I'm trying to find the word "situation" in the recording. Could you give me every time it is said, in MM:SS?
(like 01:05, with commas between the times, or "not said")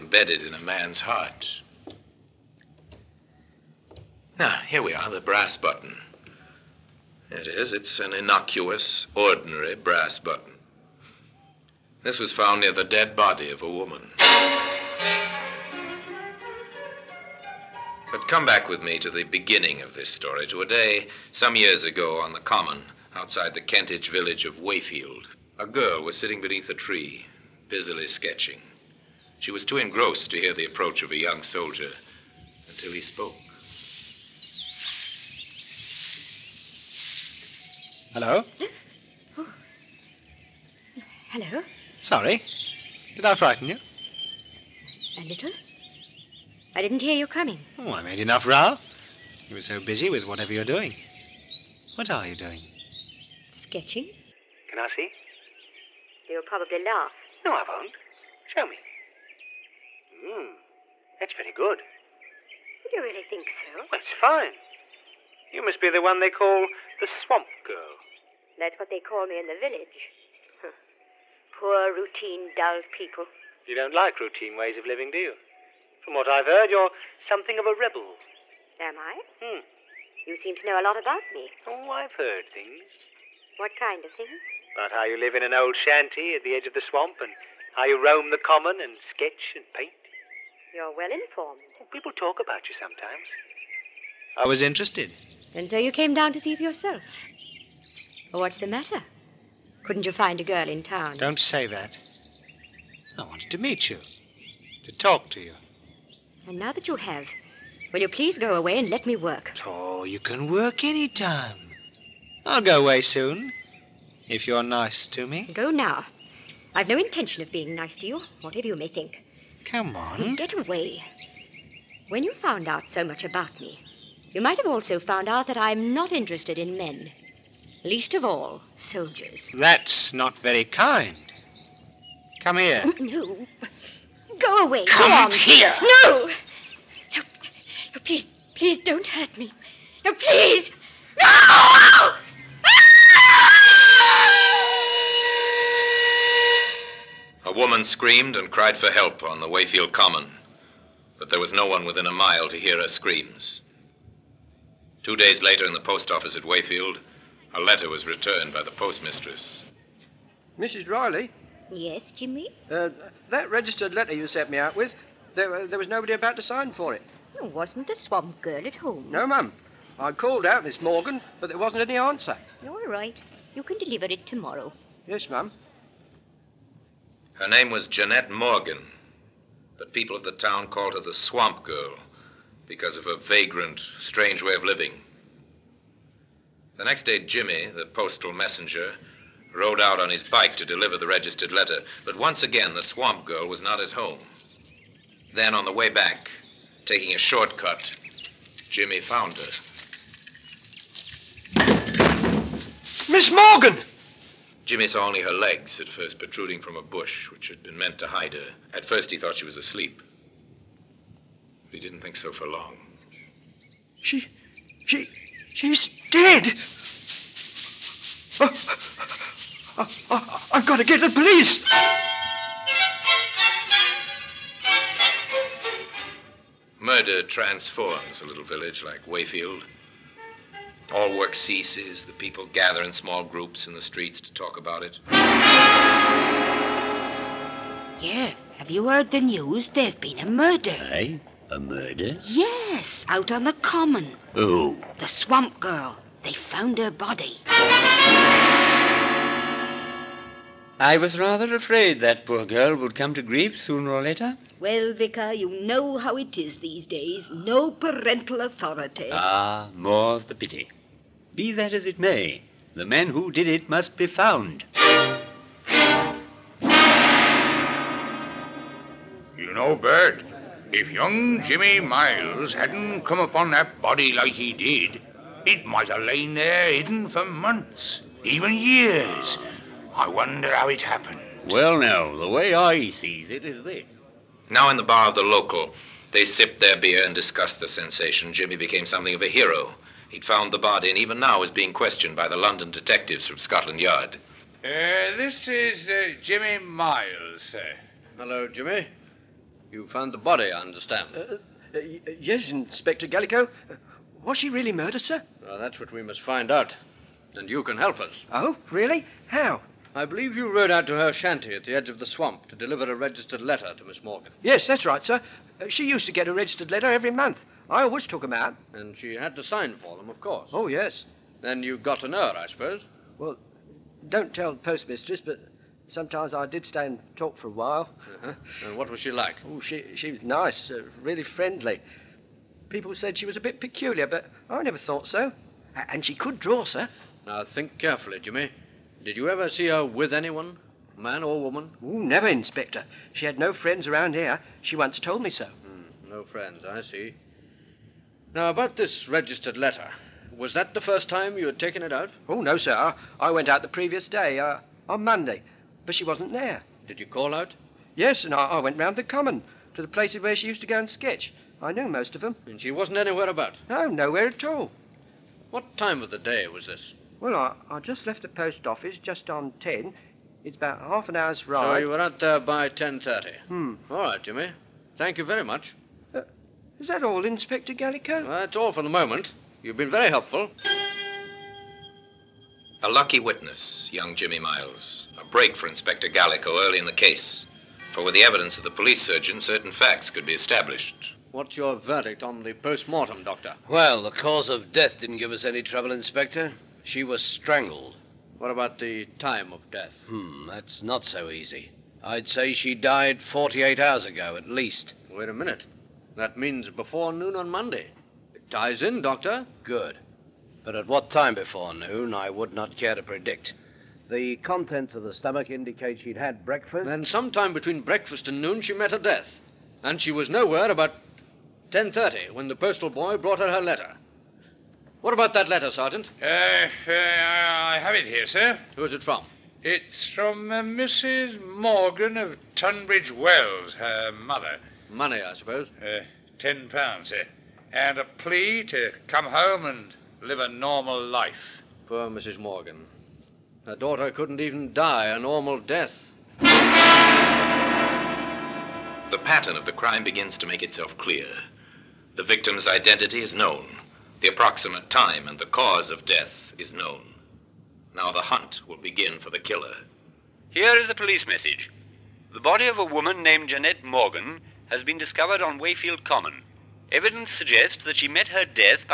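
not said.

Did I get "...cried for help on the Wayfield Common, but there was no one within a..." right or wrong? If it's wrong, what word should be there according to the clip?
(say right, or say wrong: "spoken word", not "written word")
right.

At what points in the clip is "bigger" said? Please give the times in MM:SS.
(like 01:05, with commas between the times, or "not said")
not said.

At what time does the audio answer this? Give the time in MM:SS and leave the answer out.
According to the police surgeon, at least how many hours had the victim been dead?
06:43.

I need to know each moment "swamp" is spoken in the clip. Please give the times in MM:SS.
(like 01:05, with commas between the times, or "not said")
01:07, 01:26, 02:47, 03:01, 03:12, 04:05, 05:12.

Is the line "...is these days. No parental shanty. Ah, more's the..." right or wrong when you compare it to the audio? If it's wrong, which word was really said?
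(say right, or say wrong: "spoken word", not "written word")
wrong: "authority", not "shanty".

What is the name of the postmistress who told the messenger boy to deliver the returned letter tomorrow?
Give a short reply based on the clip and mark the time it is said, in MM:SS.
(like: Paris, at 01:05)
Mrs. Riley, at 02:40.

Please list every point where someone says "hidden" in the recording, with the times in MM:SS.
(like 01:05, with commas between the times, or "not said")
04:36.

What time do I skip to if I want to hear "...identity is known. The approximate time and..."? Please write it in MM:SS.
07:32.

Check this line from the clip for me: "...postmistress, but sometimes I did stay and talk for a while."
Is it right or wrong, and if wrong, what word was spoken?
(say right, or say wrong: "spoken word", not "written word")
right.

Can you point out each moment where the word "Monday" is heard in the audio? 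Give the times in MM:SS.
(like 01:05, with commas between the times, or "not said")
05:55, 06:47.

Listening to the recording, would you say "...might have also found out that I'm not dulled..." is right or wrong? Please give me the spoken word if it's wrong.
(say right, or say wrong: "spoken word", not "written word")
wrong: "interested", not "dulled".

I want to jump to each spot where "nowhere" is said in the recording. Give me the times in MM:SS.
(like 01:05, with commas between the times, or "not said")
06:03, 07:00.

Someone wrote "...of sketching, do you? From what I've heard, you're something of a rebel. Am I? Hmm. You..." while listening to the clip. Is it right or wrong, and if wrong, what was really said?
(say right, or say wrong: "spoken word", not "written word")
wrong: "living", not "sketching".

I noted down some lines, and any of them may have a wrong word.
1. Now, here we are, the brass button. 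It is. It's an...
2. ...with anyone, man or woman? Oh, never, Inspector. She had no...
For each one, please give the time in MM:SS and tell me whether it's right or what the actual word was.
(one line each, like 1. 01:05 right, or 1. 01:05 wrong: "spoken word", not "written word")
1. 00:04 right
2. 05:39 right.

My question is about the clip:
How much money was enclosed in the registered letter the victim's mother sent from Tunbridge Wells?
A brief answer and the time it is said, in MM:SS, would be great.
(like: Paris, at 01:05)
10 pounds, at 07:16.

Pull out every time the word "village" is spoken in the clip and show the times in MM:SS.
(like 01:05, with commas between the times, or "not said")
00:24, 01:09, 03:48.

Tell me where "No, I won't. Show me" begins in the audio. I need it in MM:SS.
00:57.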